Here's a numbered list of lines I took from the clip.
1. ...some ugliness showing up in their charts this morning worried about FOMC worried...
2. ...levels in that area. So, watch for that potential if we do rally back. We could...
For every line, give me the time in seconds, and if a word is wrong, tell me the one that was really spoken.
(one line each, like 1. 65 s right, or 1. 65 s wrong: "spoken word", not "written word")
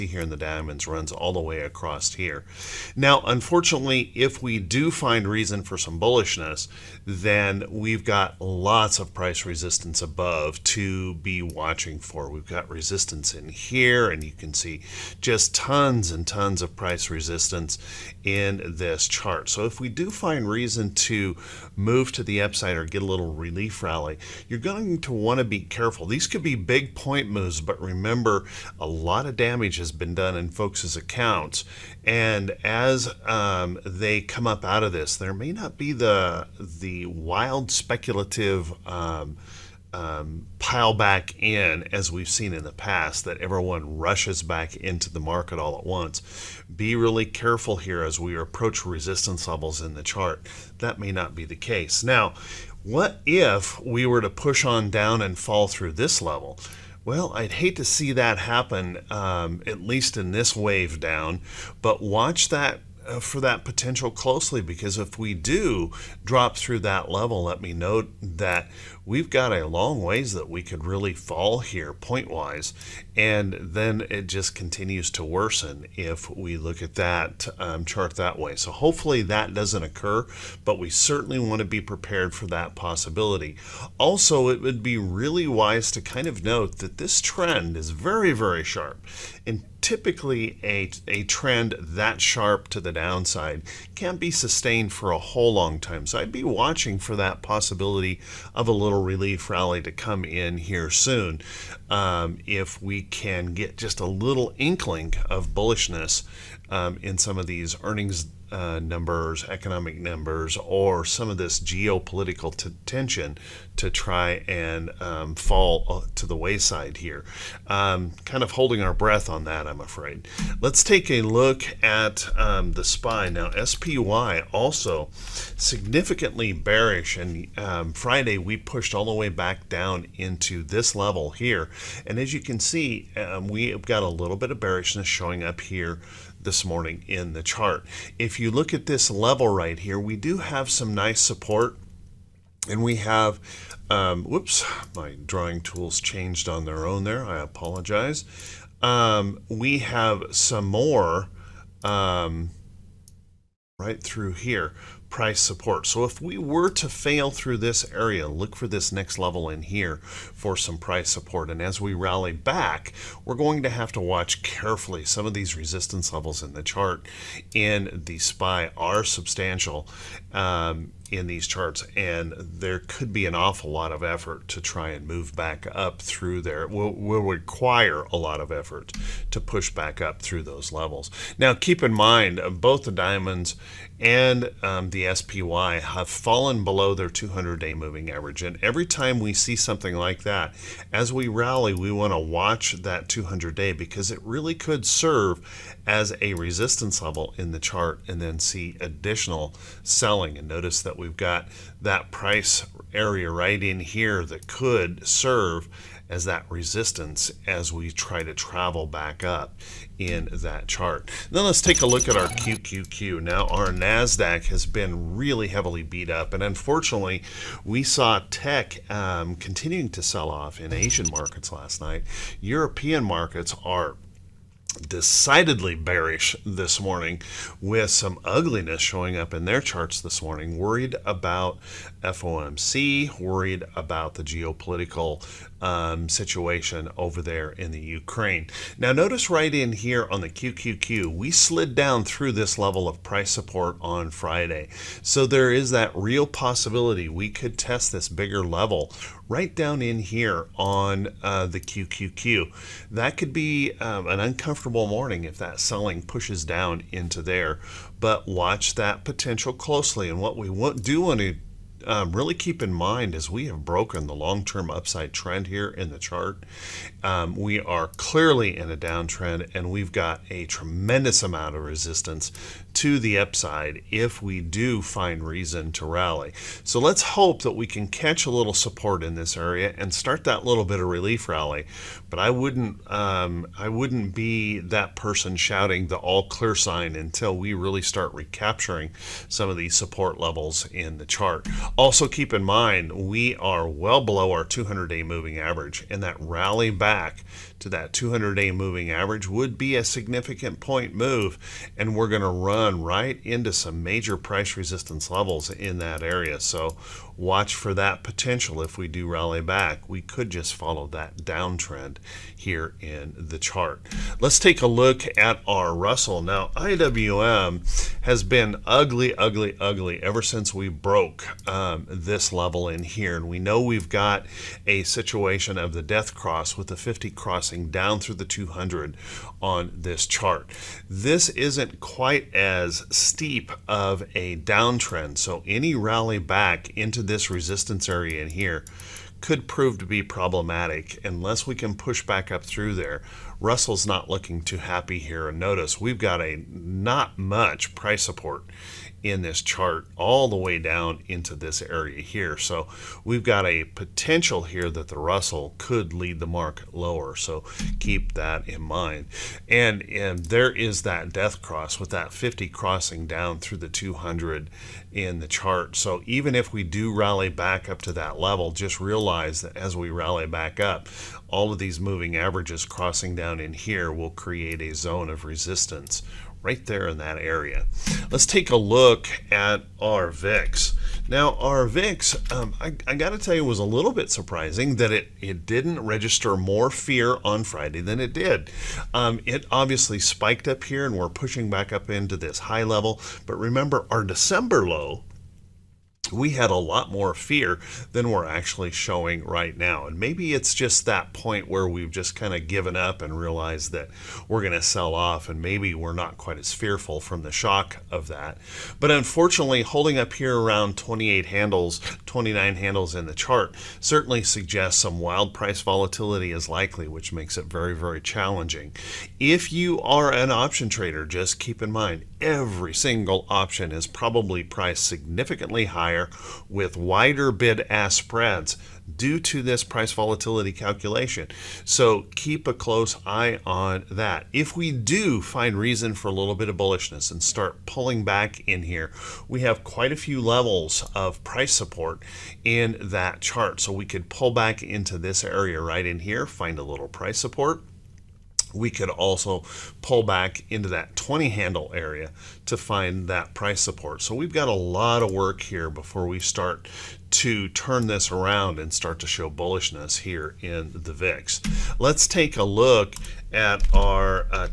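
1. 227 s right
2. 305 s right.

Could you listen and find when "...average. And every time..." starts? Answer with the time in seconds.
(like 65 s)
188 s.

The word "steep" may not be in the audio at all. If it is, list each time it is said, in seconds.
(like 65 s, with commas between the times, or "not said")
332 s.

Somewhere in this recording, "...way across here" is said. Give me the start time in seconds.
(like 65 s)
1 s.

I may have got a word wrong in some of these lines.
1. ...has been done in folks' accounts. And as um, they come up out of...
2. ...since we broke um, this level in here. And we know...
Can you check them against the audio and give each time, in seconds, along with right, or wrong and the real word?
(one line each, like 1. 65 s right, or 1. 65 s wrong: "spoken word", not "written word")
1. 29 s right
2. 320 s right.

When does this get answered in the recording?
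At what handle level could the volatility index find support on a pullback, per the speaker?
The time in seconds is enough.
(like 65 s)
450 s.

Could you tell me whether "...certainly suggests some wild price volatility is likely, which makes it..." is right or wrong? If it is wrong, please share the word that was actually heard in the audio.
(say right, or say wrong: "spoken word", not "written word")
right.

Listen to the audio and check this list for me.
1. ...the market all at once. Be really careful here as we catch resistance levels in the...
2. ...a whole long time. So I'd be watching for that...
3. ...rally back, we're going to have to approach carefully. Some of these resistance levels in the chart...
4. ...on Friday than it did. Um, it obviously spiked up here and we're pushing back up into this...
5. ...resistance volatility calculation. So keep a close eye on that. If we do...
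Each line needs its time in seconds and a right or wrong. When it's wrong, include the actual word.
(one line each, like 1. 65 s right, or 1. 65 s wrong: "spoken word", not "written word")
1. 45 s wrong: "approach", not "catch"
2. 95 s right
3. 161 s wrong: "watch", not "approach"
4. 387 s right
5. 429 s wrong: "price", not "resistance".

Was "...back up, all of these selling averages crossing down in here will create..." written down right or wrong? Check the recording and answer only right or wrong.
wrong.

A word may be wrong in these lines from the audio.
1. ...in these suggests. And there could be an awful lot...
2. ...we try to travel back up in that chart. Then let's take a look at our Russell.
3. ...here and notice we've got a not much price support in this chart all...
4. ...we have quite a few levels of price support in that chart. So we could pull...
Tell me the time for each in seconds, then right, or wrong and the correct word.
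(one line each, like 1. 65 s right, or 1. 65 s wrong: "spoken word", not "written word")
1. 171 s wrong: "charts", not "suggests"
2. 207 s wrong: "QQQ", not "Russell"
3. 344 s right
4. 439 s right.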